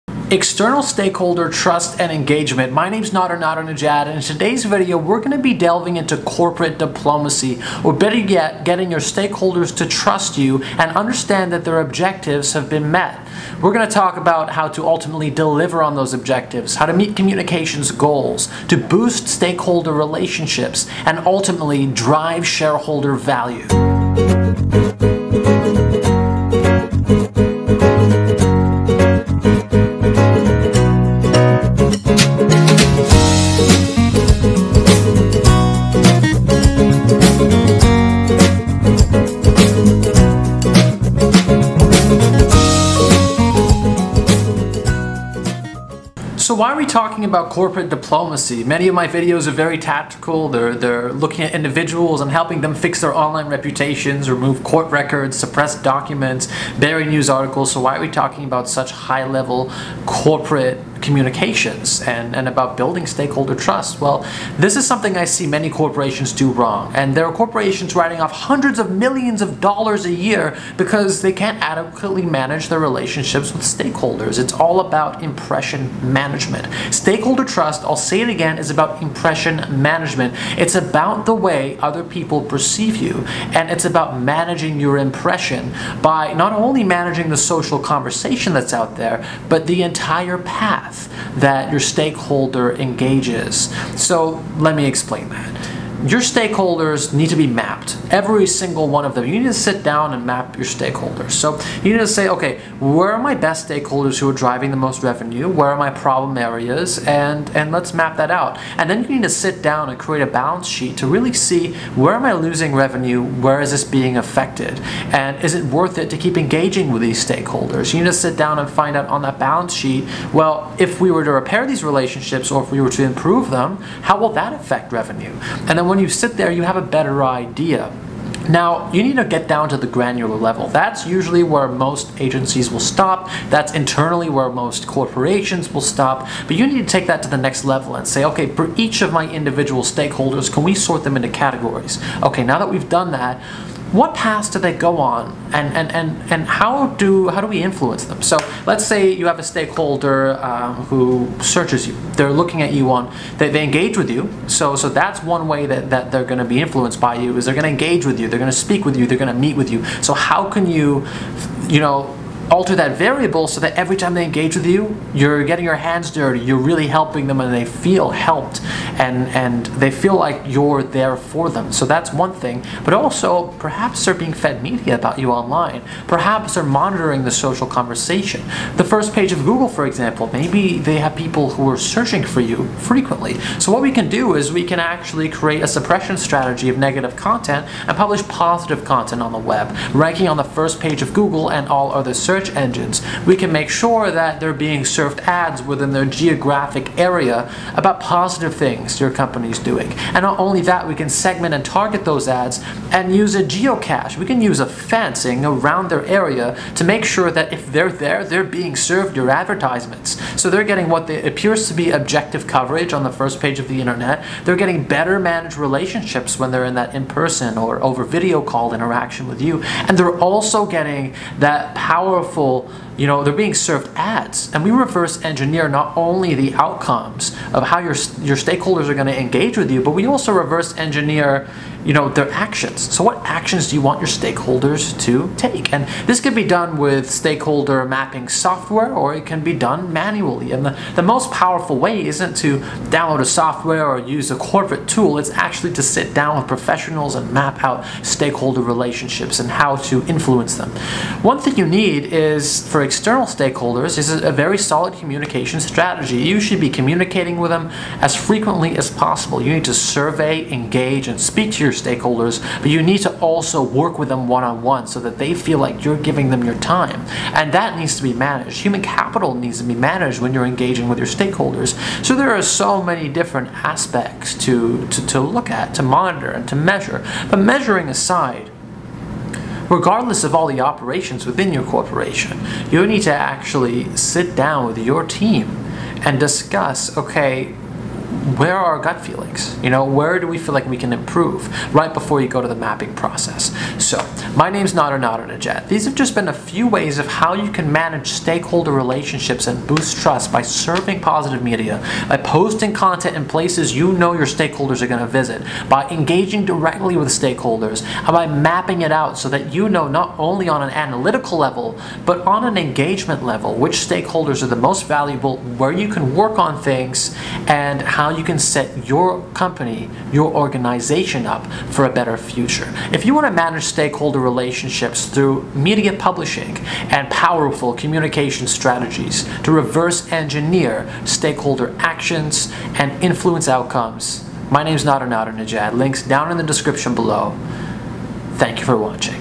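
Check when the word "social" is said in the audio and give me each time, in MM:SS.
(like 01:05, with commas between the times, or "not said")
01:27, 02:57.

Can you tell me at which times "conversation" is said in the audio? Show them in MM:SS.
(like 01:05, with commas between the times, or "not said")
01:27, 02:57.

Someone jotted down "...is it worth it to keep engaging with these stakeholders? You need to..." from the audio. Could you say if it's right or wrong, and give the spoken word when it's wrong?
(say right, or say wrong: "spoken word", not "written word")
right.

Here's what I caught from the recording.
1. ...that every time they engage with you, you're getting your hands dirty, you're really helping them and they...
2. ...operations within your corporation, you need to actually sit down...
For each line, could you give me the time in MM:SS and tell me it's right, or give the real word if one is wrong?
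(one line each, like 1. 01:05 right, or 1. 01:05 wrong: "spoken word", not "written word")
1. 02:43 right
2. 04:40 right.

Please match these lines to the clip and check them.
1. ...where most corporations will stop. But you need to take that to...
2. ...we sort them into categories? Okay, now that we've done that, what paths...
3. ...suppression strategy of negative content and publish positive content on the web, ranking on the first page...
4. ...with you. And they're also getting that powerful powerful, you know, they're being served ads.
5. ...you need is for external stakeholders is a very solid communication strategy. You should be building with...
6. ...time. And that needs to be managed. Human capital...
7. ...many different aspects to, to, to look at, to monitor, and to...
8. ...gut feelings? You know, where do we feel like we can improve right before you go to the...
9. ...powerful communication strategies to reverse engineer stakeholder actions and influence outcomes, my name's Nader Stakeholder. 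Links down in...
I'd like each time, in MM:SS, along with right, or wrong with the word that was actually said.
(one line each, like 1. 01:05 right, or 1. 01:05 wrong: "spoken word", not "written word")
1. 02:14 right
2. 02:20 right
3. 03:05 right
4. 03:39 right
5. 04:11 wrong: "communicating", not "building"
6. 04:26 right
7. 04:32 right
8. 04:48 right
9. 05:27 wrong: "Nadernejad", not "Stakeholder".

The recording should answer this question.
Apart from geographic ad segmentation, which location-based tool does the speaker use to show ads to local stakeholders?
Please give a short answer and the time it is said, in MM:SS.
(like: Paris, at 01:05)
geocache, at 03:23.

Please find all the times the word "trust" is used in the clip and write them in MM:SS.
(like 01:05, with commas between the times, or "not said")
00:01, 00:09, 01:03, 01:17, 05:00.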